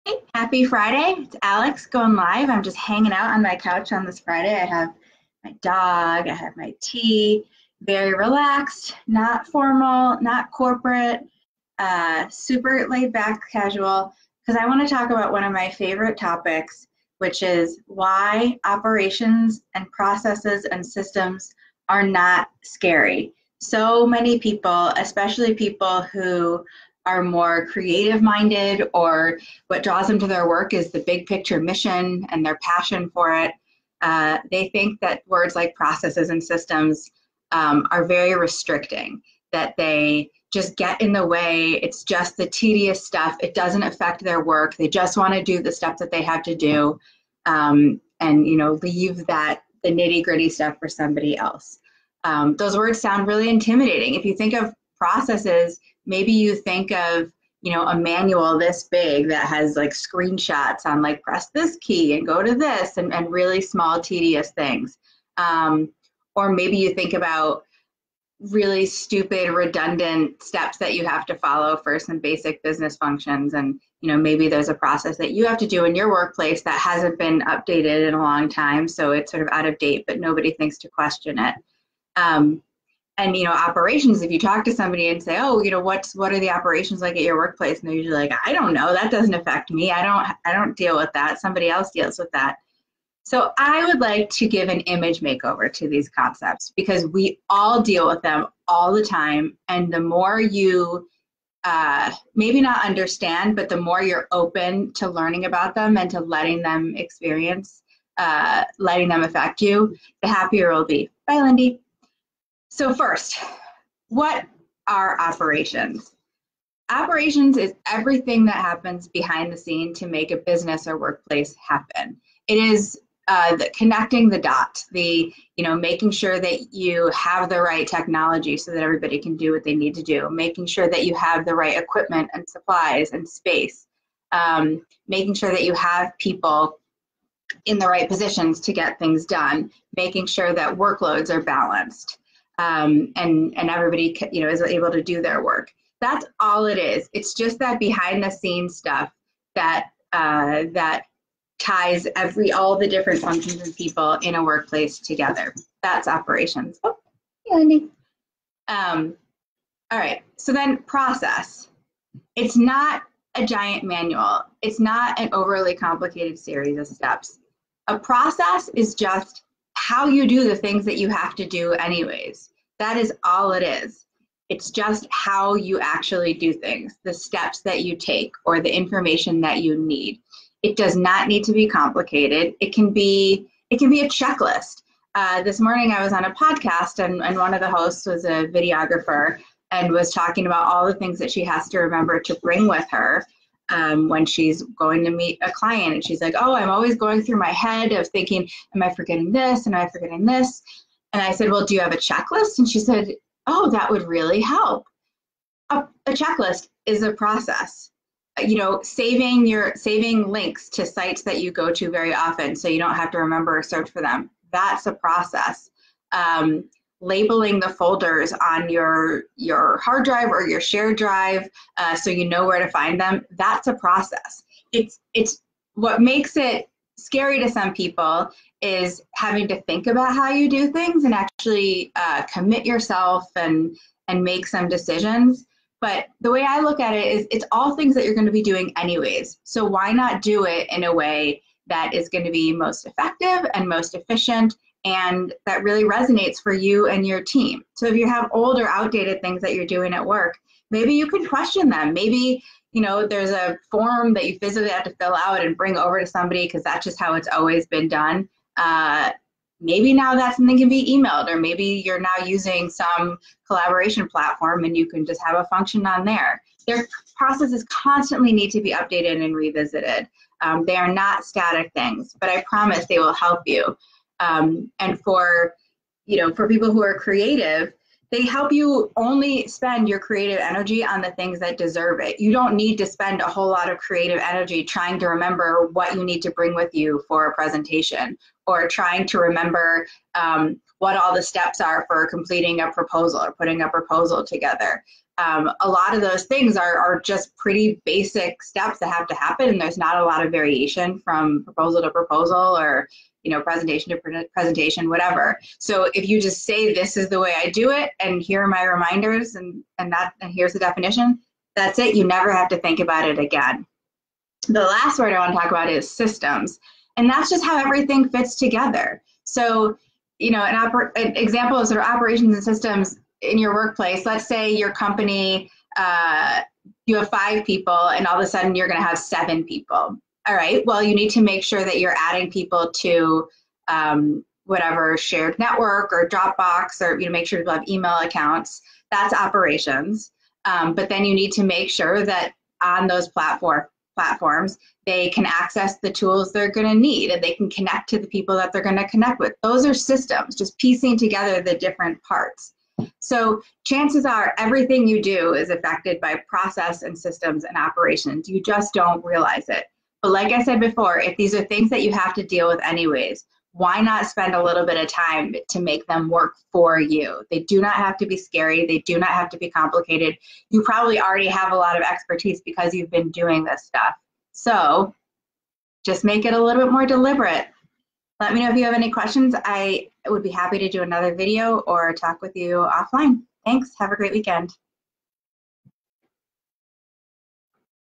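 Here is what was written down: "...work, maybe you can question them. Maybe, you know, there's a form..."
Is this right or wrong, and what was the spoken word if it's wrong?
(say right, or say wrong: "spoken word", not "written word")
right.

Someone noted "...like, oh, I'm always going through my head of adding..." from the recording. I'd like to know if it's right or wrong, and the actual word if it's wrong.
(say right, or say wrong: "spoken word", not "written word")
wrong: "thinking", not "adding".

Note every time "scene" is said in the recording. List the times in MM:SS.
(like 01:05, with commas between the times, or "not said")
01:59, 02:28.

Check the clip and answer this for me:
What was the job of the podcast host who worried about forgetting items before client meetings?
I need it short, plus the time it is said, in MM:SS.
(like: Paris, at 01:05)
videographer, at 03:08.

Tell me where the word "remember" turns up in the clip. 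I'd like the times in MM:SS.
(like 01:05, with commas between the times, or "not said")
03:11, 03:33, 04:45, 04:49.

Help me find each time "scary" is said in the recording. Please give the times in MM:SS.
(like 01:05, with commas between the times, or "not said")
00:22, 03:46, 06:08.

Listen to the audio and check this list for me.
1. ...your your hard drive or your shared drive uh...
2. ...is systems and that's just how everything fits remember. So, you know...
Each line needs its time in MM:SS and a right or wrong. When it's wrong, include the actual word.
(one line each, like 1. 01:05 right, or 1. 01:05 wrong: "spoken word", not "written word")
1. 03:38 right
2. 05:15 wrong: "together", not "remember".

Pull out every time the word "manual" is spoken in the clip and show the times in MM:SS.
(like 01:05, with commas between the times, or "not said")
00:57, 02:43.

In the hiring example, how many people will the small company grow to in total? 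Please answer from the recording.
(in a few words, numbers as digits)
7.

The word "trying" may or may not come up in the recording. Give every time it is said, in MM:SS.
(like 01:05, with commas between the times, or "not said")
04:44, 04:48.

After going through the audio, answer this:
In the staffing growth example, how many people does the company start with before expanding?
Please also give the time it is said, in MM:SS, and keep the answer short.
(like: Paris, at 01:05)
5, at 05:27.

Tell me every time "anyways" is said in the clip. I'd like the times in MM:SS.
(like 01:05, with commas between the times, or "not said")
02:51, 03:58, 06:02.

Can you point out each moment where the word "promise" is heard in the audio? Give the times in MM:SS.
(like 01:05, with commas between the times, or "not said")
04:32.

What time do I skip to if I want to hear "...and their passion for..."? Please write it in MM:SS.
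00:32.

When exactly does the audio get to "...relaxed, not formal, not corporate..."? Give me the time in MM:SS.
00:08.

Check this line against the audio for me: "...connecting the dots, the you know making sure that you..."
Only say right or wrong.
right.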